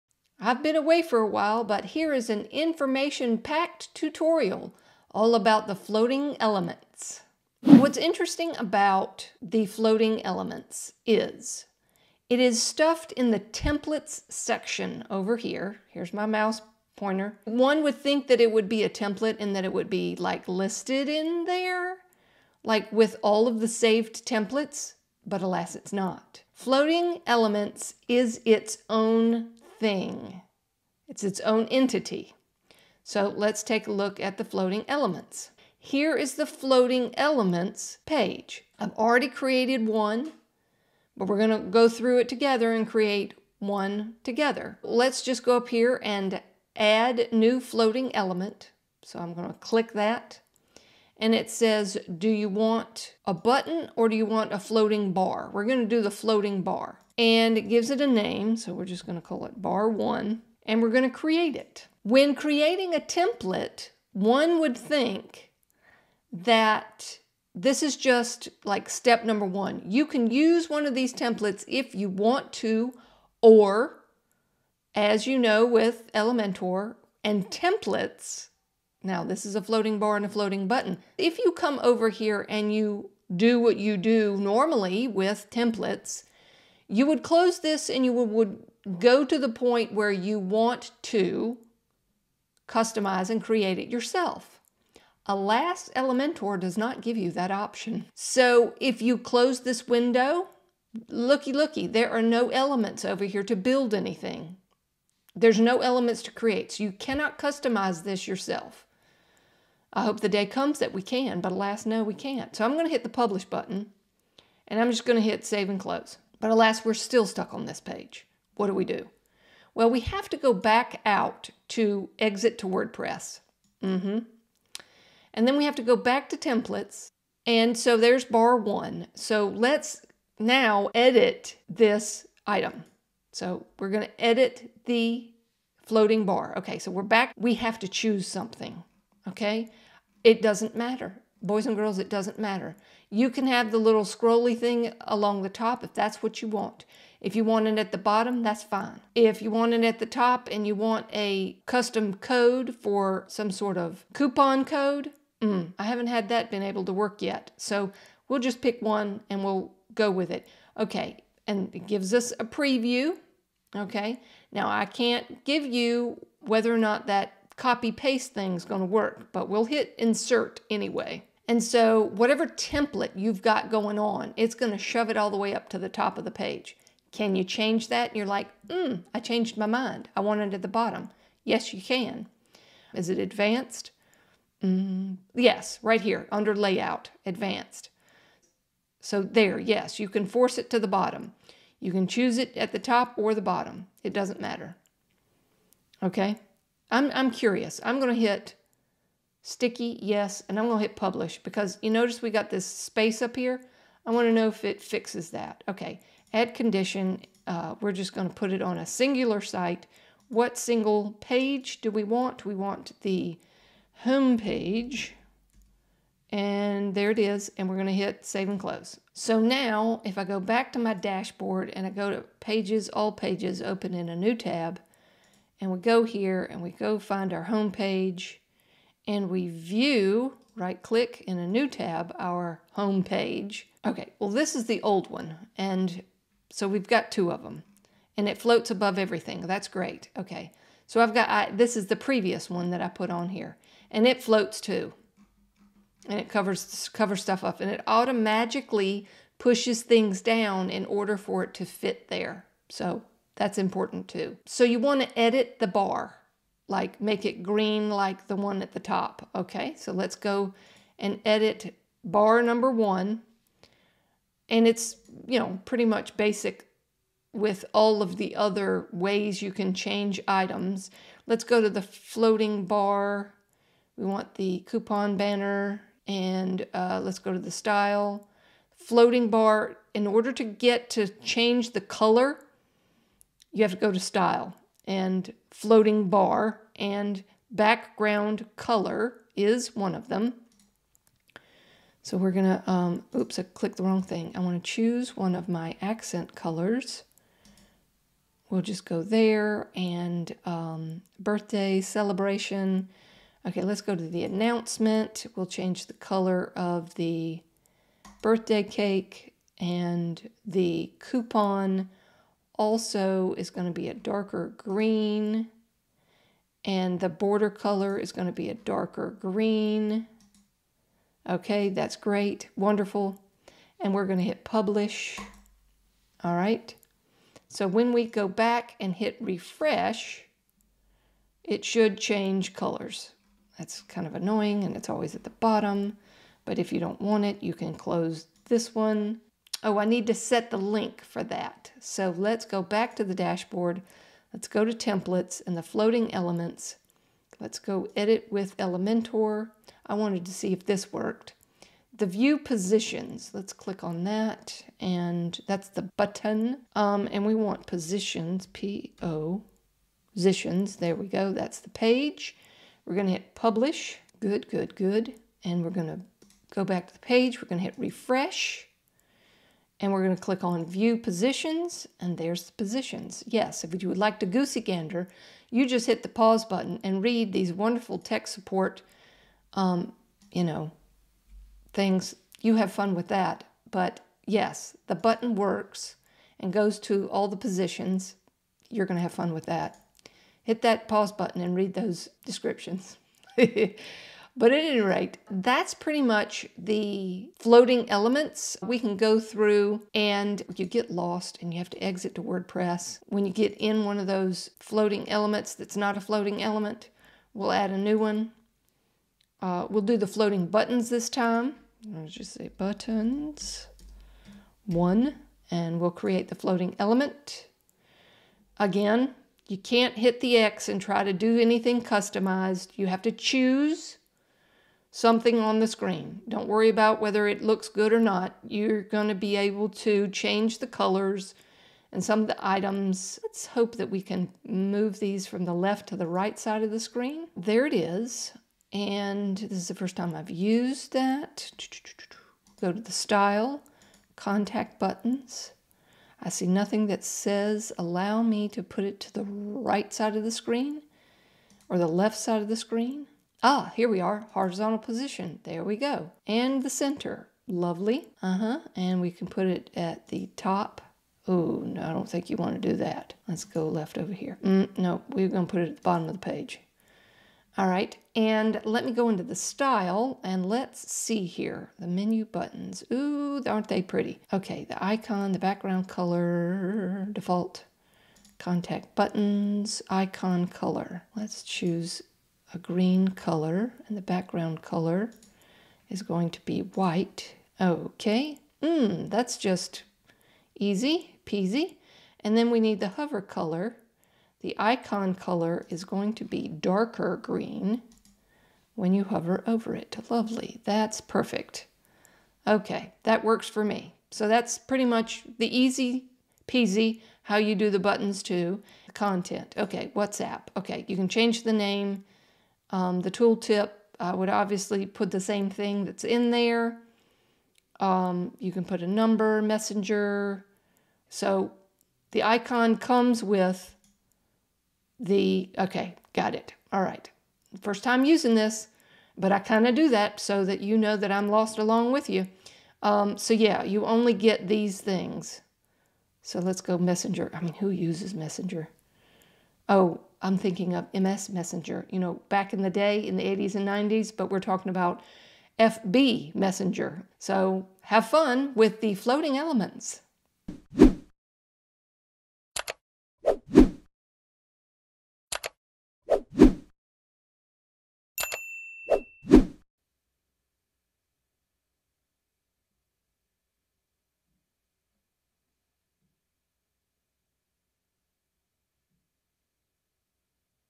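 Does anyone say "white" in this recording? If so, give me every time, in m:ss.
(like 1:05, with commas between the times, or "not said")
8:06.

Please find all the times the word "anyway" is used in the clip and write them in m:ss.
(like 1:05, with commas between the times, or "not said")
2:50.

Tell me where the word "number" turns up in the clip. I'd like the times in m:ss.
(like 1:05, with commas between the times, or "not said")
1:09, 4:22, 8:38.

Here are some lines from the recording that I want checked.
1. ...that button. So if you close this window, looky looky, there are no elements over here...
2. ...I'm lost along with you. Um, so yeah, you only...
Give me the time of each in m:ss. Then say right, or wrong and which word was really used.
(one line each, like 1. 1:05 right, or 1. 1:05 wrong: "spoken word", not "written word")
1. 1:37 wrong: "option", not "button"
2. 8:51 right.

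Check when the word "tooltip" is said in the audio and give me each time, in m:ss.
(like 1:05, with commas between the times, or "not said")
8:33.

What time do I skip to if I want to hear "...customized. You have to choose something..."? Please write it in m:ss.
7:01.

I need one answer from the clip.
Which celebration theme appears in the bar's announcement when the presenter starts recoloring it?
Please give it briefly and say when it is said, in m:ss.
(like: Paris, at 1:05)
Birthday celebration, at 5:01.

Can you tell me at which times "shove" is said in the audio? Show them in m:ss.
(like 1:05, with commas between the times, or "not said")
2:54.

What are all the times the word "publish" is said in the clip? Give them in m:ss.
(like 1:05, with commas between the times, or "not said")
1:53, 3:20, 5:24, 6:03.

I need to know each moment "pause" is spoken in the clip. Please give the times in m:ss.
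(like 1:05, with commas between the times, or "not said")
6:16, 6:30.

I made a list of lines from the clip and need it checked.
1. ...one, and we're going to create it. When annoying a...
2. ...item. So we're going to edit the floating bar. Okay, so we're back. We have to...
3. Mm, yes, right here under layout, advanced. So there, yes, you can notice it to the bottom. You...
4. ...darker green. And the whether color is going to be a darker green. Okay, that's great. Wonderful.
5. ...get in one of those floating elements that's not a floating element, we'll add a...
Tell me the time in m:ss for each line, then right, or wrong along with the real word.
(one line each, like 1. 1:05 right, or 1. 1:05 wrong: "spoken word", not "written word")
1. 0:59 wrong: "creating", not "annoying"
2. 2:12 right
3. 3:04 wrong: "force", not "notice"
4. 5:13 wrong: "border", not "whether"
5. 6:43 right.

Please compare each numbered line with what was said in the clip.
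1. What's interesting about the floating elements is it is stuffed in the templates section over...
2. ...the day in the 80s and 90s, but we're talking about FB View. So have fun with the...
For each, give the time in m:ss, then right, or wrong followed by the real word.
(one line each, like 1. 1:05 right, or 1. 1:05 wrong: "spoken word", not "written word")
1. 0:07 right
2. 9:02 wrong: "Messenger", not "View".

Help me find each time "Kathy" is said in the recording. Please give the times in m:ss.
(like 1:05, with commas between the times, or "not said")
not said.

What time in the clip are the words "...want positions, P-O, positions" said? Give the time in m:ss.
5:57.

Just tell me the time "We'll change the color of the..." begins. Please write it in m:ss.
5:05.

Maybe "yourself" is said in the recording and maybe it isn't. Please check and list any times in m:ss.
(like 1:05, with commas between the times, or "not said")
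1:33, 1:48.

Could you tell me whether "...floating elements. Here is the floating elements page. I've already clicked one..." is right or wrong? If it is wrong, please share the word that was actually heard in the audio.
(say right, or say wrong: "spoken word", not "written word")
wrong: "created", not "clicked".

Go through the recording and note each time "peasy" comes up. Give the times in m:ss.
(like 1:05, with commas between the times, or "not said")
8:11, 8:26.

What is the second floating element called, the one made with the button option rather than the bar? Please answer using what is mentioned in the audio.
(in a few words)
Buttons one.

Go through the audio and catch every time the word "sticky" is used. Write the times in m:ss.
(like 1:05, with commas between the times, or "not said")
3:19.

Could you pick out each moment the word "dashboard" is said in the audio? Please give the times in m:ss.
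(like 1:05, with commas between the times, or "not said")
3:40, 5:43.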